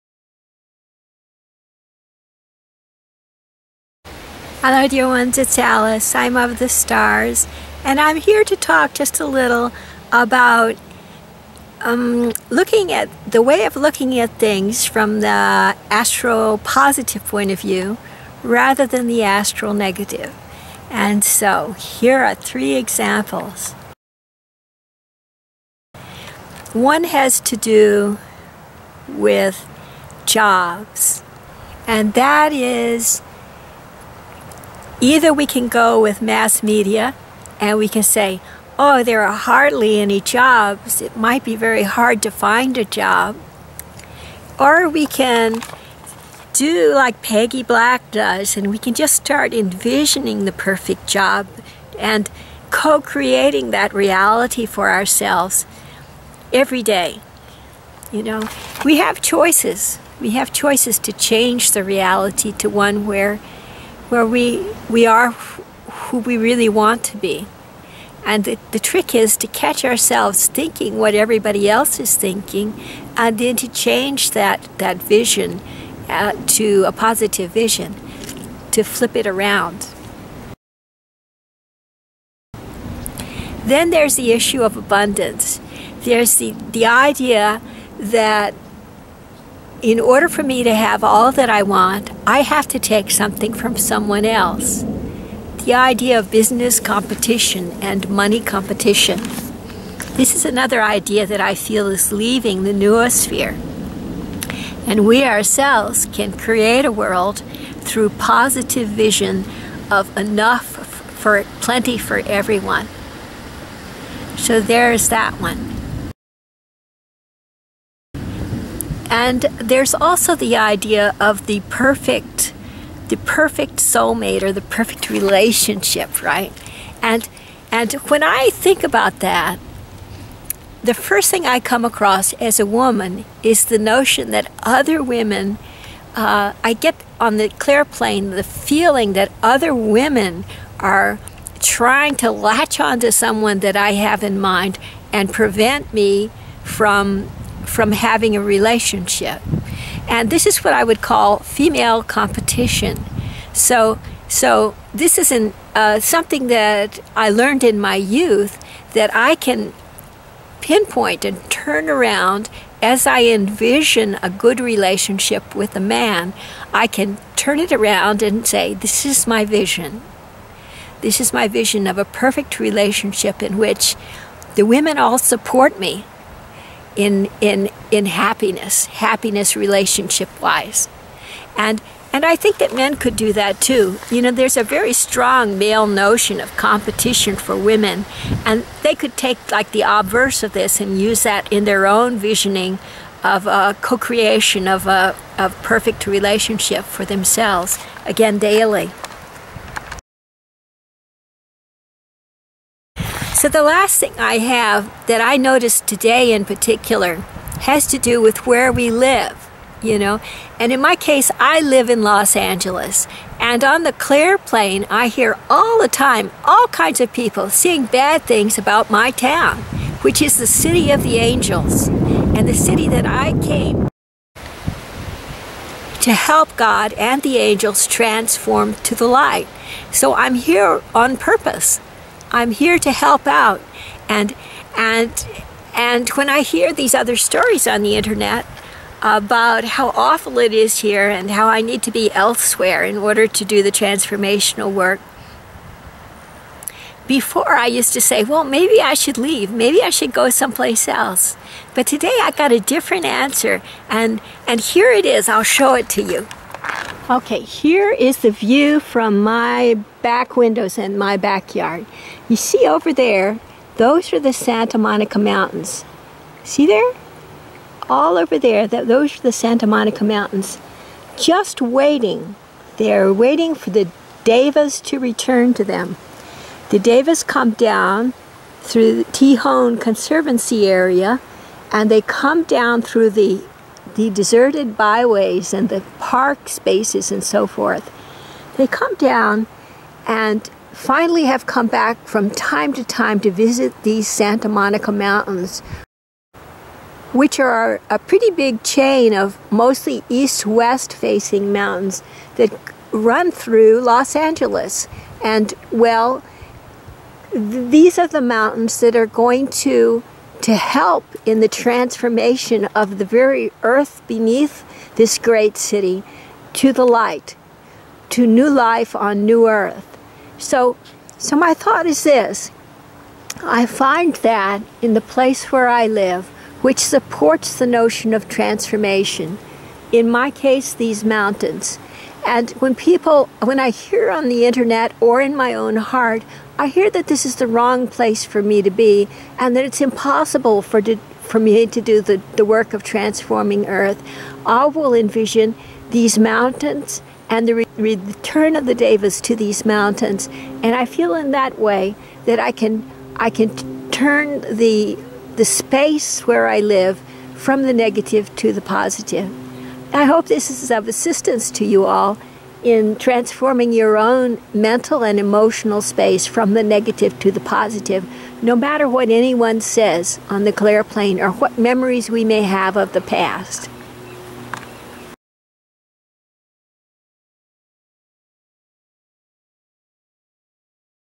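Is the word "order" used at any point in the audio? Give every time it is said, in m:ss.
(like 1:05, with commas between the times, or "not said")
1:29, 4:02.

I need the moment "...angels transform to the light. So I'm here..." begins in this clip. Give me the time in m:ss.
3:47.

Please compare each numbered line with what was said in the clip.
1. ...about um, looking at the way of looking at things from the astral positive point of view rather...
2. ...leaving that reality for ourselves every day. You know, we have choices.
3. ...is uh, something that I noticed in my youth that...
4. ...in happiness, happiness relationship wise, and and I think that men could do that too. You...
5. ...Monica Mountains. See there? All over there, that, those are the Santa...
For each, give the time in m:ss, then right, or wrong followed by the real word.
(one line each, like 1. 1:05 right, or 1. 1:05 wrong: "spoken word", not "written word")
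1. 0:10 right
2. 0:53 wrong: "creating", not "leaving"
3. 2:35 wrong: "learned", not "noticed"
4. 2:57 right
5. 4:24 right.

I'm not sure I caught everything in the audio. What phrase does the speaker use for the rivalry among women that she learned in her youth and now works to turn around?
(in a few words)
female competition.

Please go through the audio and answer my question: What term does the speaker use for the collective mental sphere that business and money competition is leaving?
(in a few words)
noosphere.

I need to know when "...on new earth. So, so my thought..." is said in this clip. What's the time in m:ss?
5:18.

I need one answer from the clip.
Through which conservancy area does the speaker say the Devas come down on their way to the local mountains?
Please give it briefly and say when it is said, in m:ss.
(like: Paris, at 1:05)
Tejon Conservancy, at 4:39.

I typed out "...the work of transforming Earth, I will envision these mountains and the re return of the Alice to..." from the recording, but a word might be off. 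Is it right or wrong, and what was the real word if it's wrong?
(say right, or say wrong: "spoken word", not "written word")
wrong: "Devas", not "Alice".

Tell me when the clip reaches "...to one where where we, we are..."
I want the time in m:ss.
1:02.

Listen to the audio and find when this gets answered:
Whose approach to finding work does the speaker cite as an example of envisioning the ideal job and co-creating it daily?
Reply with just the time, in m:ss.
0:47.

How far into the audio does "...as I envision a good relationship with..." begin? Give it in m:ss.
2:42.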